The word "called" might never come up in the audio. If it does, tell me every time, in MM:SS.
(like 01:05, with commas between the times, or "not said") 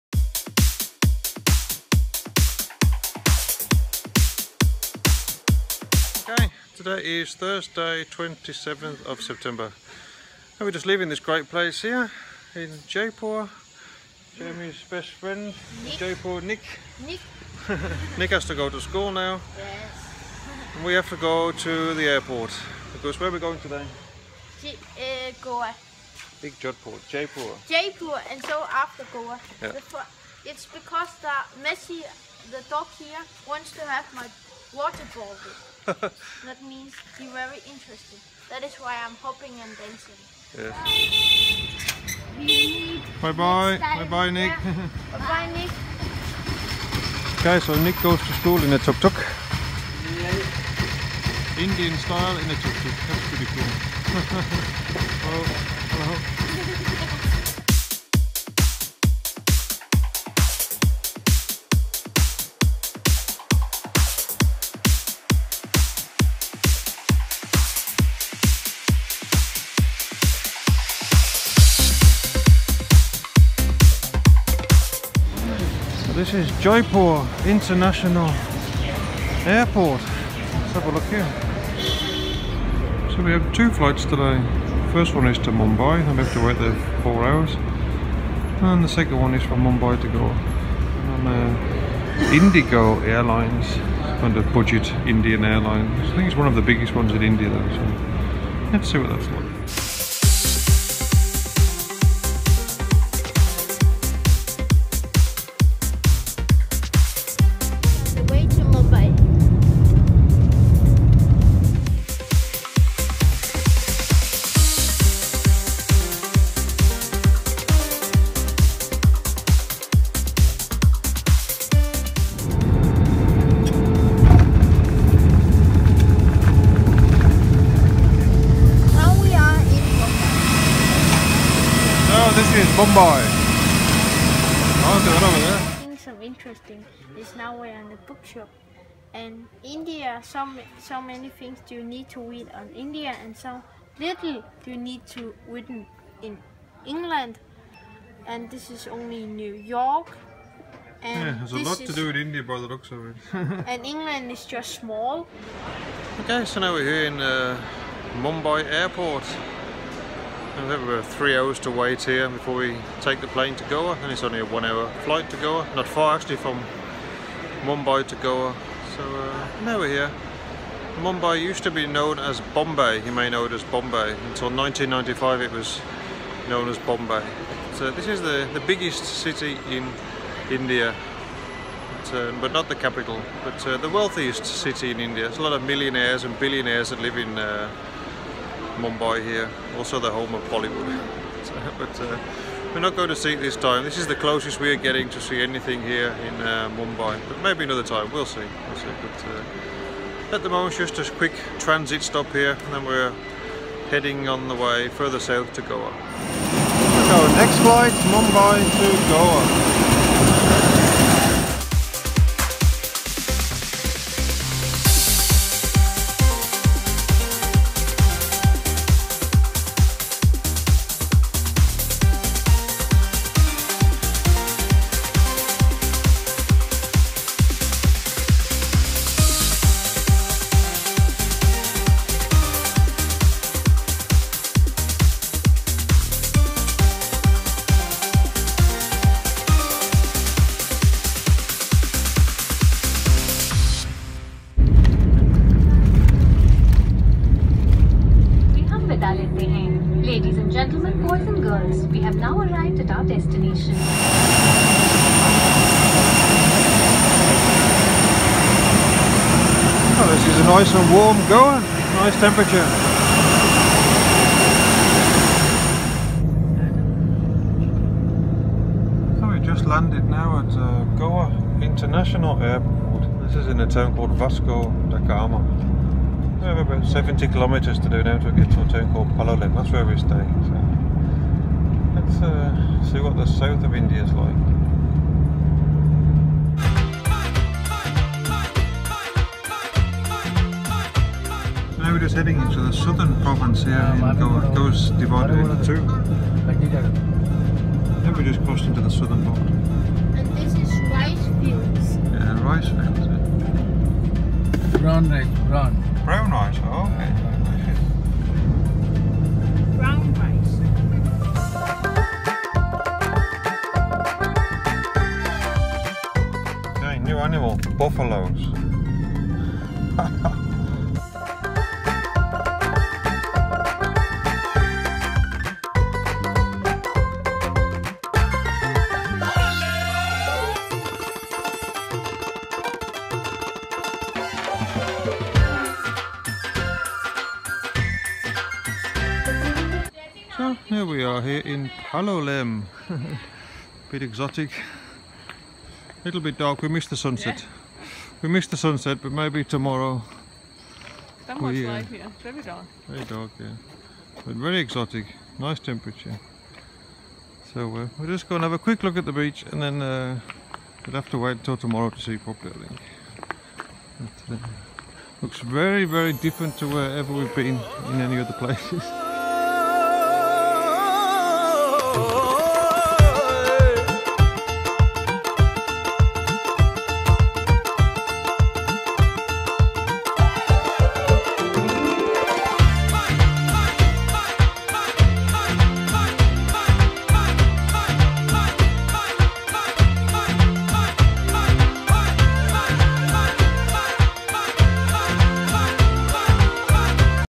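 04:33, 04:38.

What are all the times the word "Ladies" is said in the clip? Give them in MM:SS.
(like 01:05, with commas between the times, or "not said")
04:10.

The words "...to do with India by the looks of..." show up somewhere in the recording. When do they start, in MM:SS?
02:31.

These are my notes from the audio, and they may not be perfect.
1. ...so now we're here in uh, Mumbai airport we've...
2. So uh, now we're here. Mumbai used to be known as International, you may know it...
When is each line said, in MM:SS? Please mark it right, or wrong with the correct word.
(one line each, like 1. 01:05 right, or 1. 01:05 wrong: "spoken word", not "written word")
1. 02:36 right
2. 02:48 wrong: "Bombay", not "International".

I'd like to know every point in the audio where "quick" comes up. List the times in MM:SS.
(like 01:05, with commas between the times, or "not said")
03:21, 05:58.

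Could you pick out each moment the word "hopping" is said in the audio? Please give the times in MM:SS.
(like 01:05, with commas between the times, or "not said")
00:39.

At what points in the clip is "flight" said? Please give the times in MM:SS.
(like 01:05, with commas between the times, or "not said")
01:23, 02:45, 03:27.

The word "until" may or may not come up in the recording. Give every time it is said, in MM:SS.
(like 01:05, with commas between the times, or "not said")
02:54, 06:01.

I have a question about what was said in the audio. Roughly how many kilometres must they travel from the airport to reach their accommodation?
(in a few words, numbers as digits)
70.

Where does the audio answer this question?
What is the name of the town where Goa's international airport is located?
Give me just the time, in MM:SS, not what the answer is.
04:34.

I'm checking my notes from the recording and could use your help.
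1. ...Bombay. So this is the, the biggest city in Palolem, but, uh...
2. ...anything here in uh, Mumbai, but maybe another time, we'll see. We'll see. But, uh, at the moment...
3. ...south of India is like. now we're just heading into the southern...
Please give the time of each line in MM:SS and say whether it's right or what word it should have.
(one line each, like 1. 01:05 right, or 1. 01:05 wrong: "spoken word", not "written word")
1. 02:56 wrong: "India", not "Palolem"
2. 03:15 right
3. 04:43 right.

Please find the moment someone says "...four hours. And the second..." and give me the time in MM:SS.
01:27.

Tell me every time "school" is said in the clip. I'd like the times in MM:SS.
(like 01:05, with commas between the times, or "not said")
00:18, 00:48.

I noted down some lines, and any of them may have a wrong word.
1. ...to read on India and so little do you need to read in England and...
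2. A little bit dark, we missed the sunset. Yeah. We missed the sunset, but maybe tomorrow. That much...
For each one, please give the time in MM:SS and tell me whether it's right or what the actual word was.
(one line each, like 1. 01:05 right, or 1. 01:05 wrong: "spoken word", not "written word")
1. 02:22 right
2. 05:45 right.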